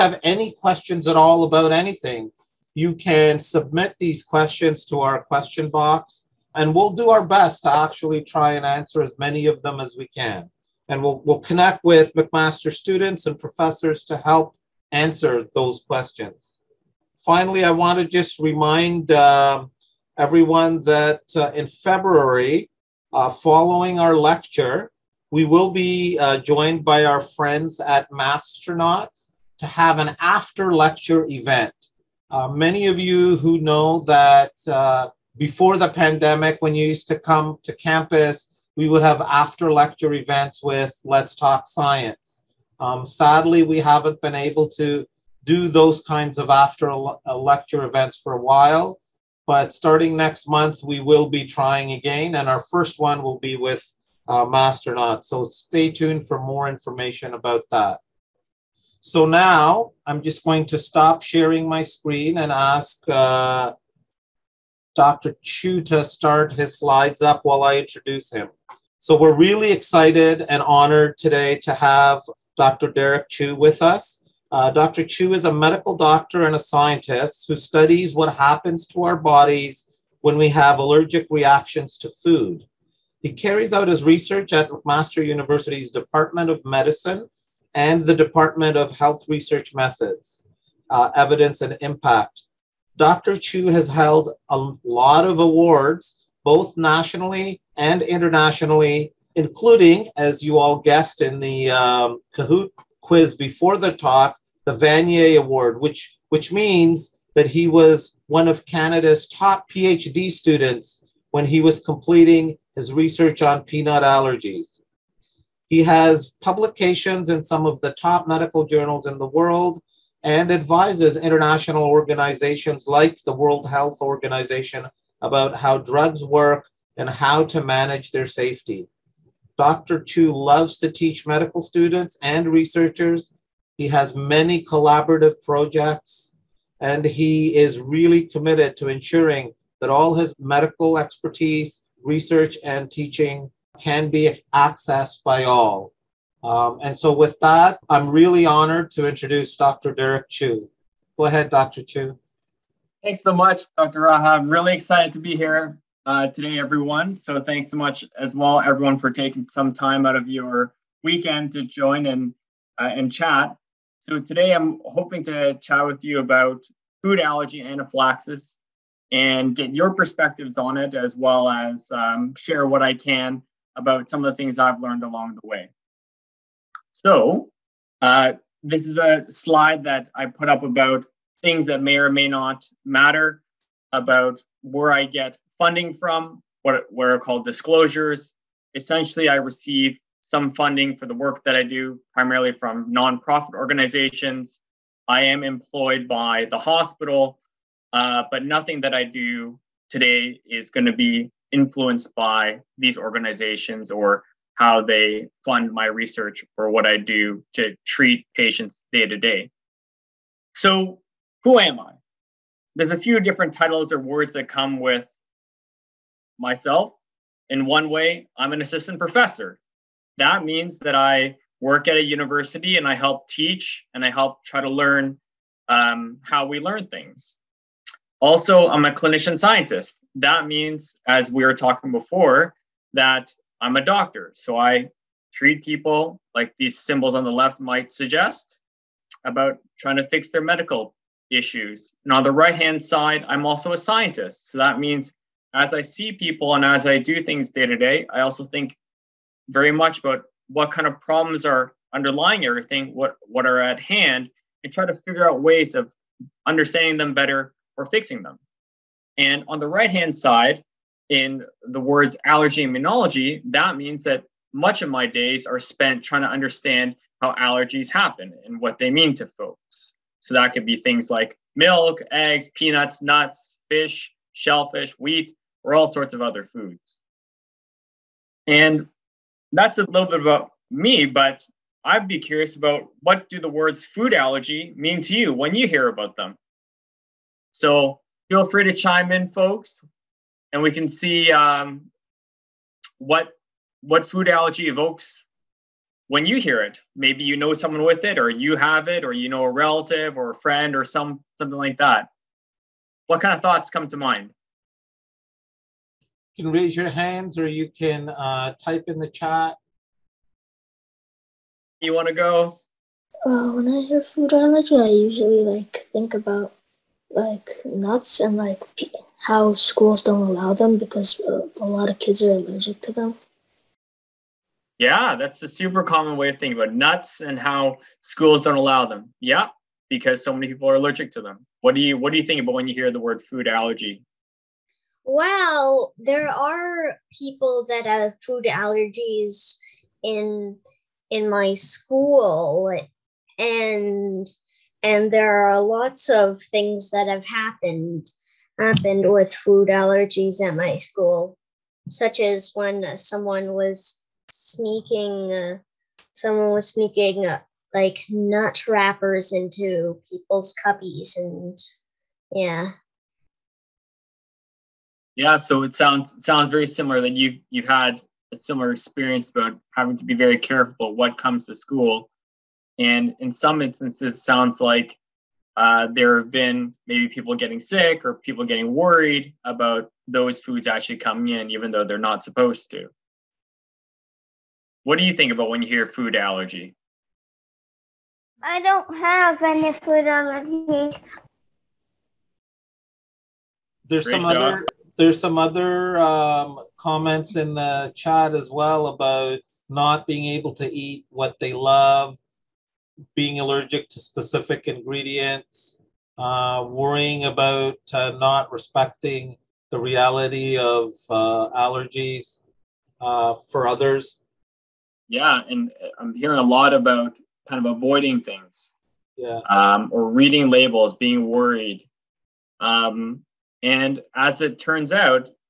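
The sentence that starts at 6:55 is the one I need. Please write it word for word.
Yeah, and uh, I'm hearing a lot about kind of avoiding things.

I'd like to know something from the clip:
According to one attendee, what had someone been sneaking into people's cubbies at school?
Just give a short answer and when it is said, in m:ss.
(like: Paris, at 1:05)
Nut wrappers, at 5:58.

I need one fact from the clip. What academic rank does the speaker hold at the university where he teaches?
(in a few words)
Assistant professor.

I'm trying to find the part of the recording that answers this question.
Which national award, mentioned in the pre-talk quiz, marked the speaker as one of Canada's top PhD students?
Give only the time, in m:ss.
1:44.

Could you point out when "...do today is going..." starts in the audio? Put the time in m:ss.
3:19.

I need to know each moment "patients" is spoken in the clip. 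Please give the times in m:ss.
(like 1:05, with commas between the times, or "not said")
3:28.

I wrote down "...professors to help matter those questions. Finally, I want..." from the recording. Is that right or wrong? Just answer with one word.
wrong.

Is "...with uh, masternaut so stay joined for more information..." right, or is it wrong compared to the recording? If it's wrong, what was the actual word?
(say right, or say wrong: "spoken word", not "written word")
wrong: "tuned", not "joined".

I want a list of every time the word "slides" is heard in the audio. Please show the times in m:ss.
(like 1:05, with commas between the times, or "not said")
1:06, 2:59.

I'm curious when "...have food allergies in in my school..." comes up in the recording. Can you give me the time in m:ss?
5:37.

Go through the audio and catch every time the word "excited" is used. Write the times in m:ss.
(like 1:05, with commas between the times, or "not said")
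1:09, 2:34.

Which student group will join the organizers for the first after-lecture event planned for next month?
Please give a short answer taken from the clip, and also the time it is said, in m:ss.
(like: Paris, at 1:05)
Masternauts, at 0:28.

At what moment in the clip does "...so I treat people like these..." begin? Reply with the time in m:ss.
3:54.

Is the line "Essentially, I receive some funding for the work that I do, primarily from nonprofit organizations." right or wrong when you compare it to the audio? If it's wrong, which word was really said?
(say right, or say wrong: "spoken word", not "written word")
right.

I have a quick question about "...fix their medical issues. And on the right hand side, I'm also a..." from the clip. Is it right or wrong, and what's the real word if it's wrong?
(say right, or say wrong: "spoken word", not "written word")
right.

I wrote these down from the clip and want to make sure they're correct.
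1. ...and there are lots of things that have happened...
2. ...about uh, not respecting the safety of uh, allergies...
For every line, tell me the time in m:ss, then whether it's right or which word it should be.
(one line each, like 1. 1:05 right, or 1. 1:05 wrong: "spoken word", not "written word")
1. 5:44 right
2. 6:47 wrong: "reality", not "safety".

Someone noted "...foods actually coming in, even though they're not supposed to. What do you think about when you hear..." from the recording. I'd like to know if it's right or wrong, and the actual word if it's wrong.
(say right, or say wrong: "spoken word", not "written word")
right.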